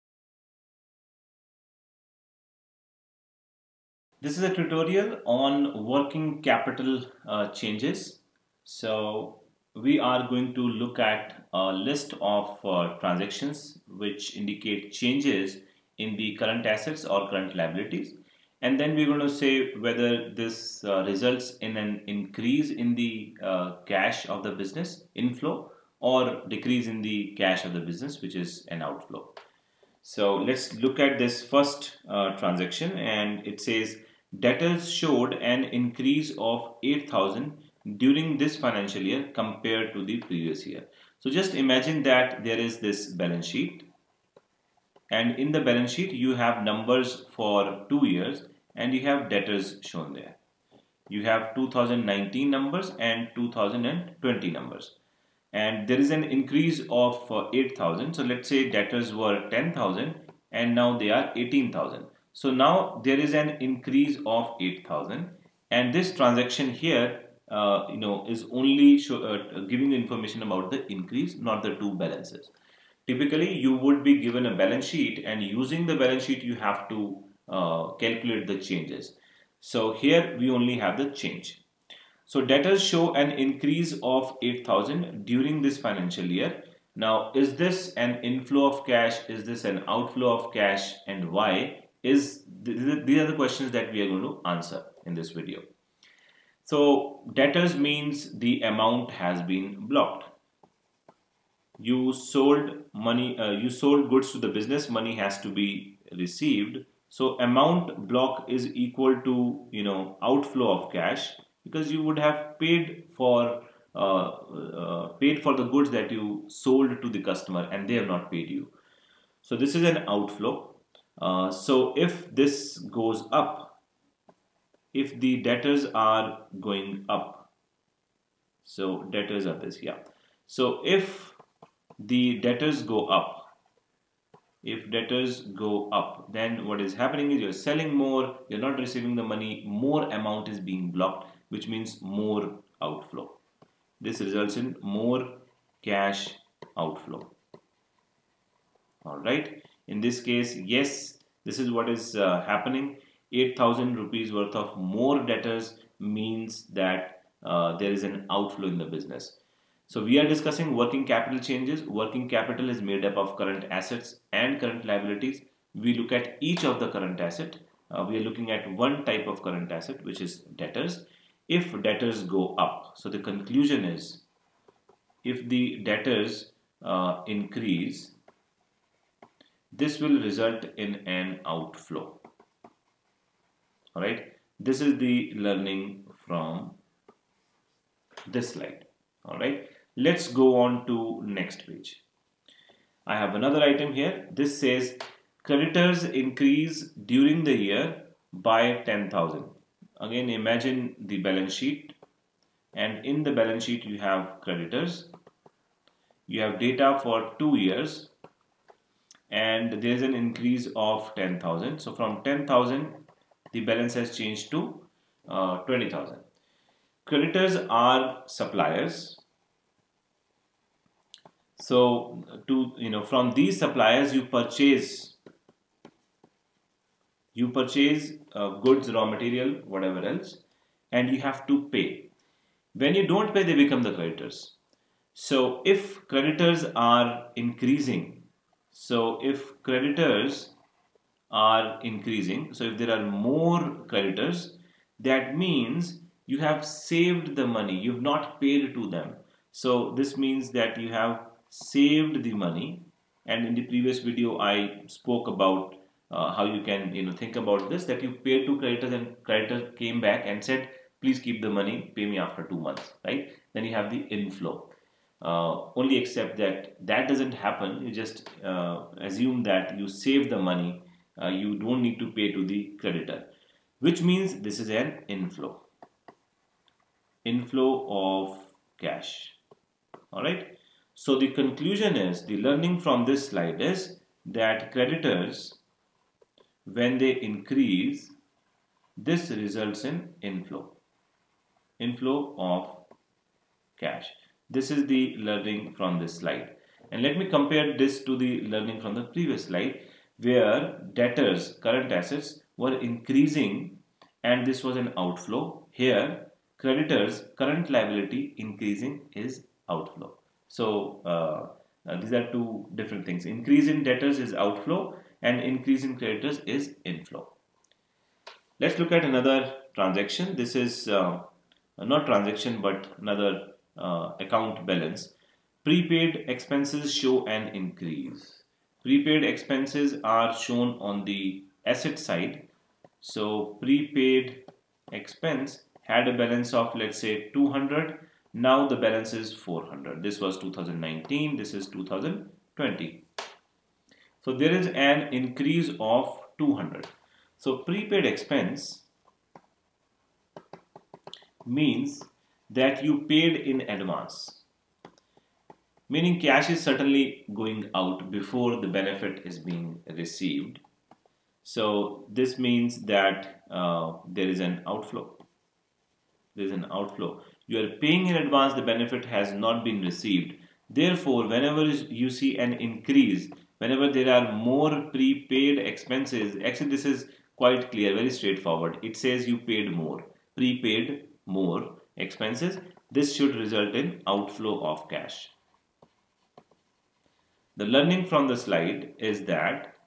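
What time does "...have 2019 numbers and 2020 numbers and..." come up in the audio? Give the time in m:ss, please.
0:51.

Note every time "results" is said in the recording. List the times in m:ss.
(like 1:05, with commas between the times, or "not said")
0:21, 2:24, 3:00, 4:49, 6:23.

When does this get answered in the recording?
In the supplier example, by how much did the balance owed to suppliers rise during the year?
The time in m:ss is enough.
3:15.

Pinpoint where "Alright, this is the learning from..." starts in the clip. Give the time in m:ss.
3:03.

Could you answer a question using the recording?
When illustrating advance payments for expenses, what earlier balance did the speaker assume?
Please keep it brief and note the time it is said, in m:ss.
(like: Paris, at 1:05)
200, at 5:36.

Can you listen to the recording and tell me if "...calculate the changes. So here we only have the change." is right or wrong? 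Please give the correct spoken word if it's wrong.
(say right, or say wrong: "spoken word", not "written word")
right.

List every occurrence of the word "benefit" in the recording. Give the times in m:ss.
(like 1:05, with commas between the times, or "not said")
5:58, 6:08.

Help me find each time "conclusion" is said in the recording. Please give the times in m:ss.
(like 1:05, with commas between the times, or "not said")
2:53, 4:41.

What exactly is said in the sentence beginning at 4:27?
You just uh, assume that you save the money.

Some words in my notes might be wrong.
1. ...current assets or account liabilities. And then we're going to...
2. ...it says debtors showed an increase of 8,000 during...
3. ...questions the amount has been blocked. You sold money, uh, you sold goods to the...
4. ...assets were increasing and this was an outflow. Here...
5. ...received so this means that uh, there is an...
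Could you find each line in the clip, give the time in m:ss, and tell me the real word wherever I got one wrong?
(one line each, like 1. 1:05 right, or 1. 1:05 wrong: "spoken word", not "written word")
1. 0:16 wrong: "current", not "account"
2. 0:33 right
3. 1:37 wrong: "means", not "questions"
4. 5:01 right
5. 5:59 right.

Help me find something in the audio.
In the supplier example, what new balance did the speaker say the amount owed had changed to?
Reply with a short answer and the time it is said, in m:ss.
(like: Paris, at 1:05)
20,000, at 3:35.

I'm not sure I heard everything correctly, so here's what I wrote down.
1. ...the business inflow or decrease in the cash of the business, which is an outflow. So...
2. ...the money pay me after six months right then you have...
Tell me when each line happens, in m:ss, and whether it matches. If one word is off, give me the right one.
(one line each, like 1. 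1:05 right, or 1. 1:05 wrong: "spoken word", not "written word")
1. 0:24 right
2. 4:21 wrong: "two", not "six".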